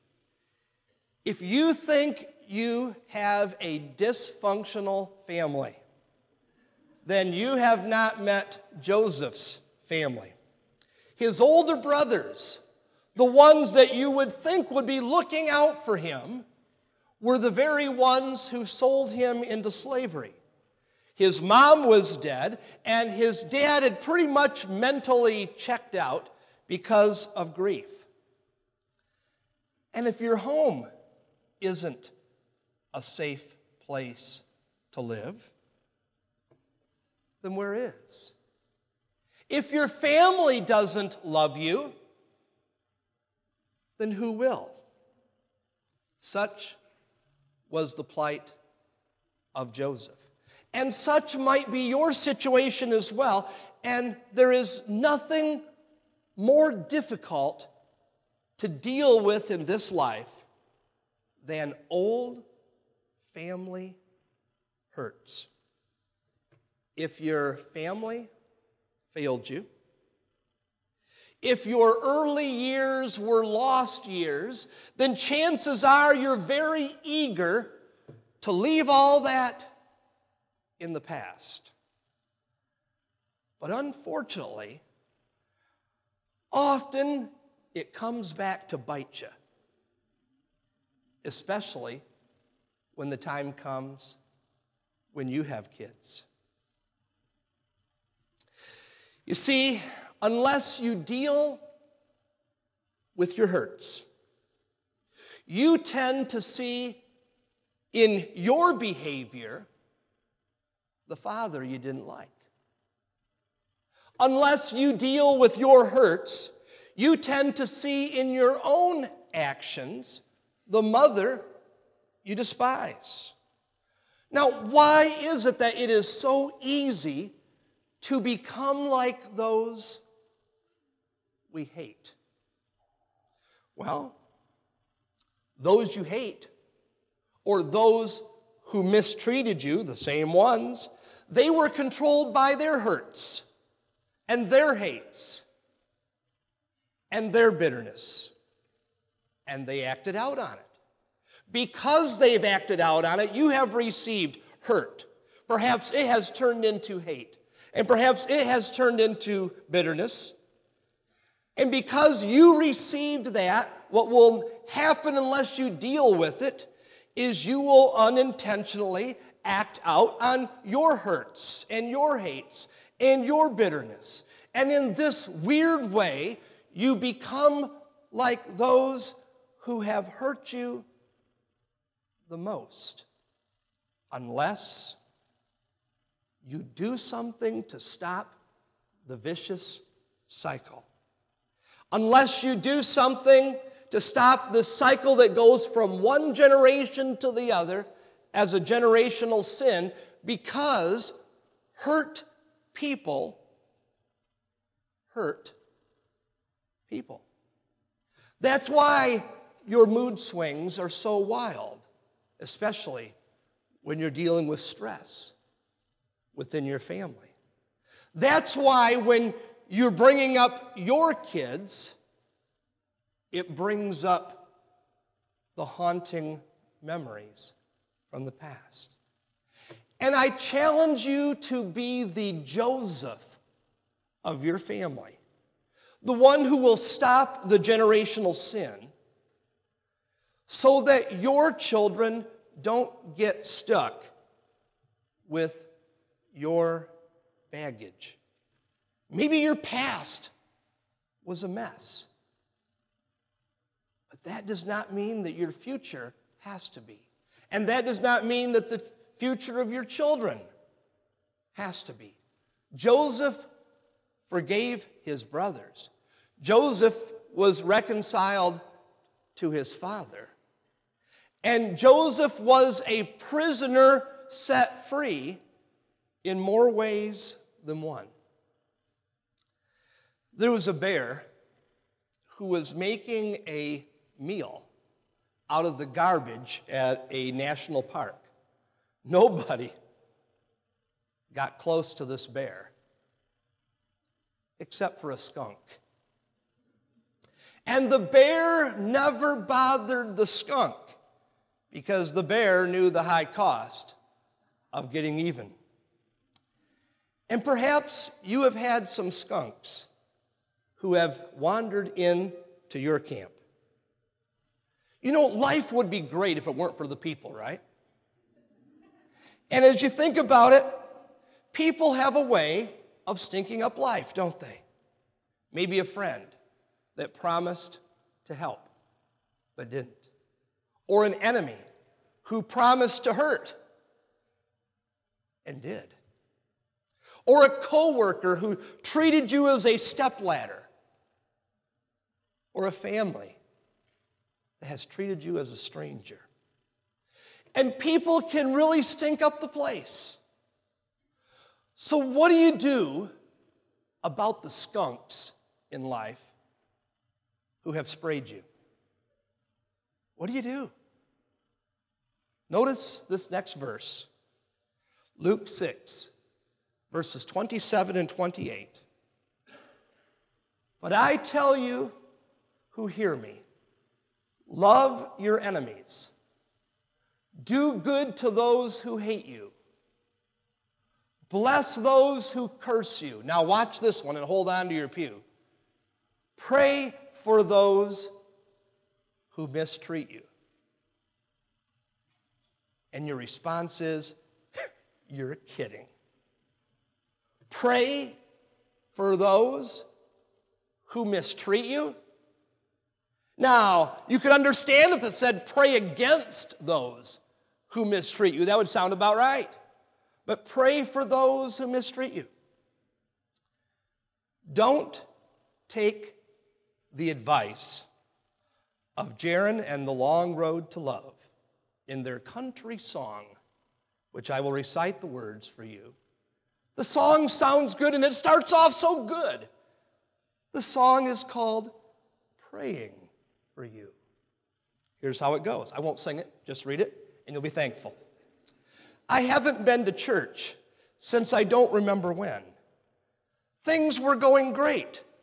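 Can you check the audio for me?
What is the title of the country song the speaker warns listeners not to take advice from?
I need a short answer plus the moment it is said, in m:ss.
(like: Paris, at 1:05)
Praying for You, at 7:12.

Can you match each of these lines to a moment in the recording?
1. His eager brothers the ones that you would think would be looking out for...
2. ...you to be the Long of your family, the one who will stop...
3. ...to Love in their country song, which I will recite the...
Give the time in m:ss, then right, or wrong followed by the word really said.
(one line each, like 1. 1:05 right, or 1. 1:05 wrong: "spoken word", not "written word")
1. 0:11 wrong: "older", not "eager"
2. 3:51 wrong: "Joseph", not "Long"
3. 7:00 right.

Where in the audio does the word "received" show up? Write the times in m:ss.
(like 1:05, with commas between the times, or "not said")
2:33, 2:42.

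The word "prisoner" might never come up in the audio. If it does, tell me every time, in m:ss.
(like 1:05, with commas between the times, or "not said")
4:33.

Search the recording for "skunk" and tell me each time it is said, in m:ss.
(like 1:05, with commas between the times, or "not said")
4:55, 5:00, 5:09, 5:54.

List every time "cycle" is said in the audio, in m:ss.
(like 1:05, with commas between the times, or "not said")
3:10, 3:14.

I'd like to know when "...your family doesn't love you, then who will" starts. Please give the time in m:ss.
0:39.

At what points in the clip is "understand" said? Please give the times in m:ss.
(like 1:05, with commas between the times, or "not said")
6:44.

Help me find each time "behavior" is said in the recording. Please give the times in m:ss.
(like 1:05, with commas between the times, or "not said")
1:48.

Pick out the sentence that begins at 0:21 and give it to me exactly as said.
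His mom was dead, and his dad had pretty much mentally checked out because of grief.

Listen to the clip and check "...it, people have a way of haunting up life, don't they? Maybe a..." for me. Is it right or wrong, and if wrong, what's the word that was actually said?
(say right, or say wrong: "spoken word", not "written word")
wrong: "stinking", not "haunting".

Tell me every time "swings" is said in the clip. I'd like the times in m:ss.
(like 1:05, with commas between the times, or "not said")
3:30.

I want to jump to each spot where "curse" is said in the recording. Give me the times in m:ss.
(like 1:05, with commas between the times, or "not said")
6:22.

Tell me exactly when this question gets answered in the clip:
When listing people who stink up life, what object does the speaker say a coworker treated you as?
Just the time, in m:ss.
5:39.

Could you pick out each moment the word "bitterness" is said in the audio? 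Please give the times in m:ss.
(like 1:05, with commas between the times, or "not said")
2:27, 2:39, 2:53.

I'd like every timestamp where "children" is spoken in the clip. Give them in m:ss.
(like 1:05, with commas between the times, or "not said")
4:01, 4:19.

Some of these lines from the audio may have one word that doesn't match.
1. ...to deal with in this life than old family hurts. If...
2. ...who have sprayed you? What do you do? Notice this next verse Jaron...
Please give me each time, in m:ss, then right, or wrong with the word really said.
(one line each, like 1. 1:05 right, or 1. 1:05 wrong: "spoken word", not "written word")
1. 0:58 right
2. 5:57 wrong: "Luke", not "Jaron".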